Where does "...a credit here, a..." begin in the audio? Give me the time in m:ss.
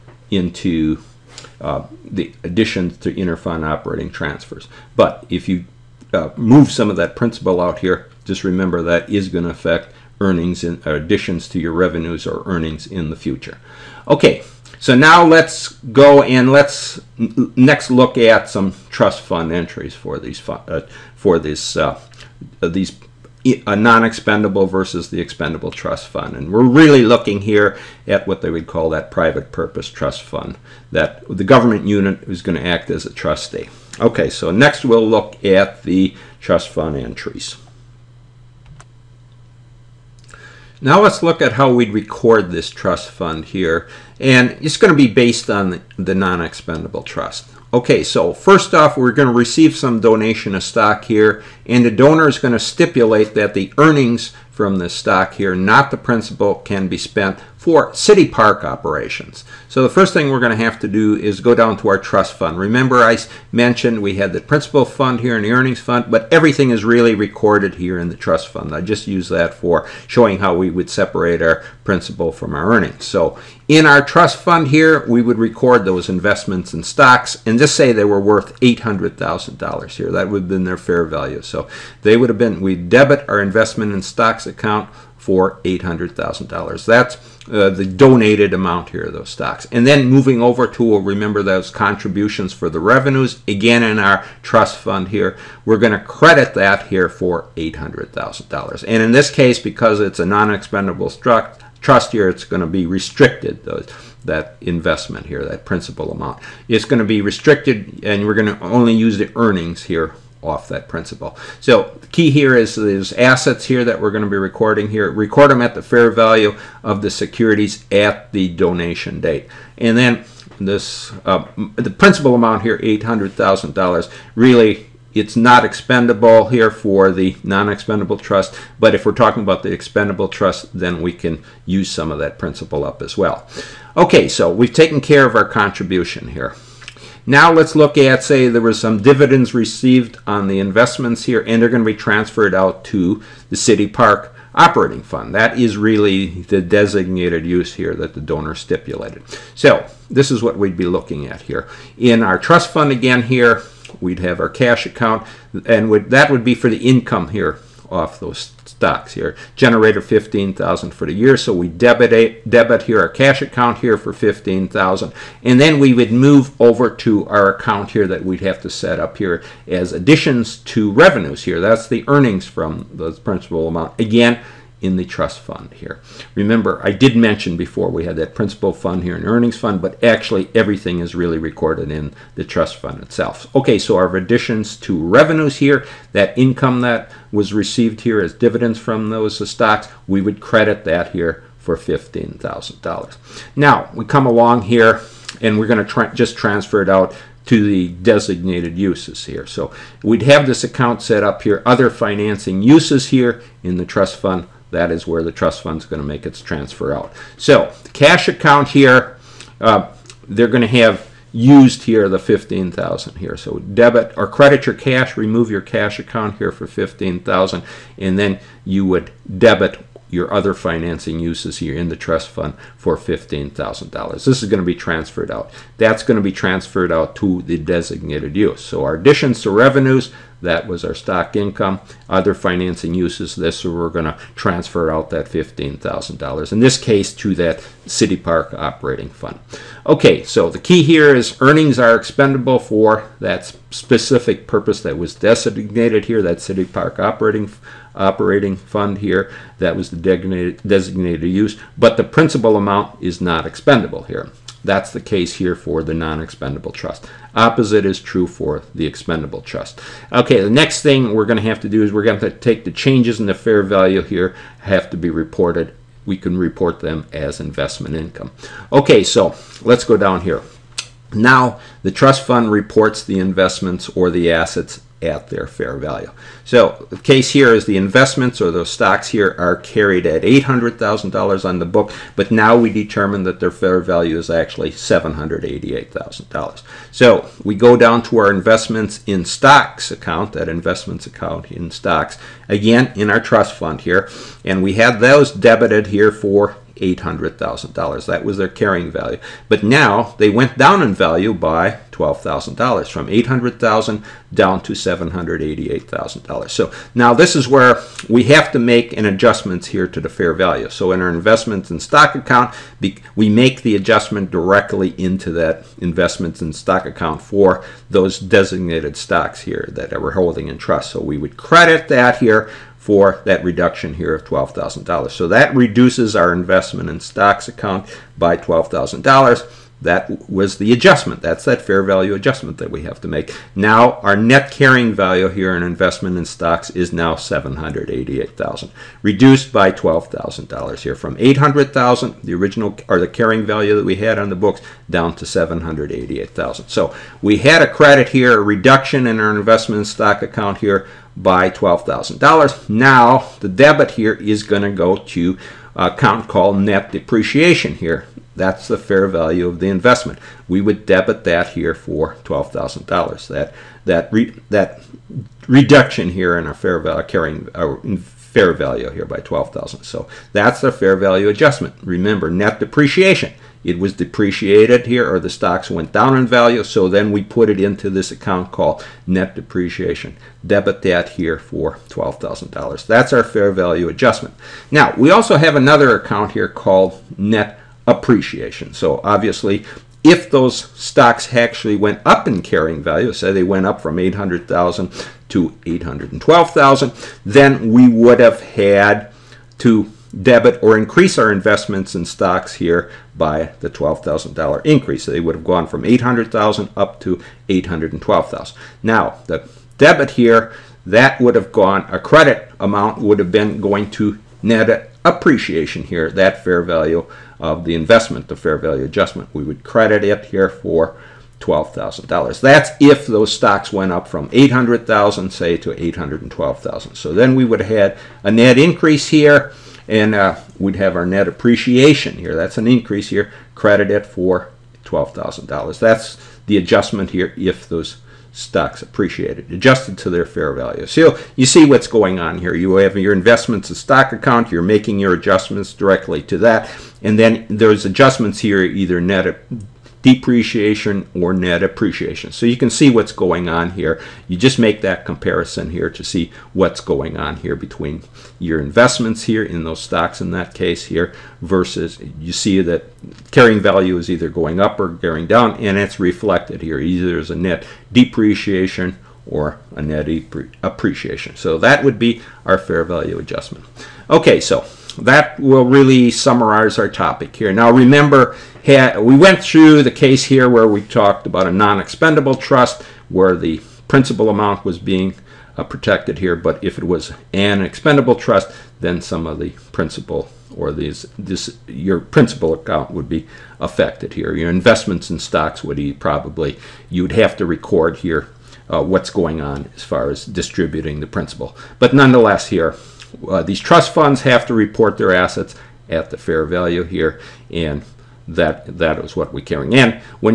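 5:47.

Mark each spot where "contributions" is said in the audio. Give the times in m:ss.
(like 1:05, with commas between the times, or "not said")
1:31, 2:15.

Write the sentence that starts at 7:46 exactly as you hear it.
Either as a net depreciation or a net appreciation.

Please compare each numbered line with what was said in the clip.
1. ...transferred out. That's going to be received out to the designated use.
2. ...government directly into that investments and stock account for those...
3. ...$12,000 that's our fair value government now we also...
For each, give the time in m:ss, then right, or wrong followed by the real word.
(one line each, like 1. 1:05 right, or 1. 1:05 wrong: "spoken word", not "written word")
1. 3:44 wrong: "transferred", not "received"
2. 5:13 wrong: "adjustment", not "government"
3. 6:21 wrong: "adjustment", not "government".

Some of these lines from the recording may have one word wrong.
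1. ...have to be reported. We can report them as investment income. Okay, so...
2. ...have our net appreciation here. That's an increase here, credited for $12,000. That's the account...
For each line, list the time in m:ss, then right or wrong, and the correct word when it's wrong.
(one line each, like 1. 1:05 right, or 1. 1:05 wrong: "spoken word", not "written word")
1. 4:24 right
2. 7:10 wrong: "adjustment", not "account".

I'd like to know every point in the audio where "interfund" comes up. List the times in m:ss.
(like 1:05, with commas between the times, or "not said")
0:03.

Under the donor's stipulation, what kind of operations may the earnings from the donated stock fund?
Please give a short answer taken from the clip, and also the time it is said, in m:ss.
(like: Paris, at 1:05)
city park operations, at 0:57.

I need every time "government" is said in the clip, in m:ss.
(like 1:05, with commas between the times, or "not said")
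0:31.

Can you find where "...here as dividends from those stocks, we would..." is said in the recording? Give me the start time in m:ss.
3:08.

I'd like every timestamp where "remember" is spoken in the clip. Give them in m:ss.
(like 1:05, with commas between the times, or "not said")
0:08, 1:02, 1:31, 2:56, 6:11, 7:57.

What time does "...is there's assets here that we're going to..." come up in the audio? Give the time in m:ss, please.
1:52.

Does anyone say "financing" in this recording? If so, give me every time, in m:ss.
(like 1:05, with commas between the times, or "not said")
3:21, 3:40, 3:52.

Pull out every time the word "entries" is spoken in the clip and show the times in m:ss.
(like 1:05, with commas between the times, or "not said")
0:19, 0:36.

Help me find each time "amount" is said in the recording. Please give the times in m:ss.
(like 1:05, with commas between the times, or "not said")
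1:28, 1:46, 2:02, 2:53, 4:12, 6:52, 8:04.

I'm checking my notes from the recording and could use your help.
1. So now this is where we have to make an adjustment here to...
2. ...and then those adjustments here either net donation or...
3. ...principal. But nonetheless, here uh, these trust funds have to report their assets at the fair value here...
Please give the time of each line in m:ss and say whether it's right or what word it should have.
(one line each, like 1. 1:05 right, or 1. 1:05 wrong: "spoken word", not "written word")
1. 5:06 right
2. 7:27 wrong: "depreciation", not "donation"
3. 8:21 right.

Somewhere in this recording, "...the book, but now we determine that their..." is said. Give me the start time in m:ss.
4:41.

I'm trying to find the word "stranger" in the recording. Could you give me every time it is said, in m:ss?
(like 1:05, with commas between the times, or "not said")
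not said.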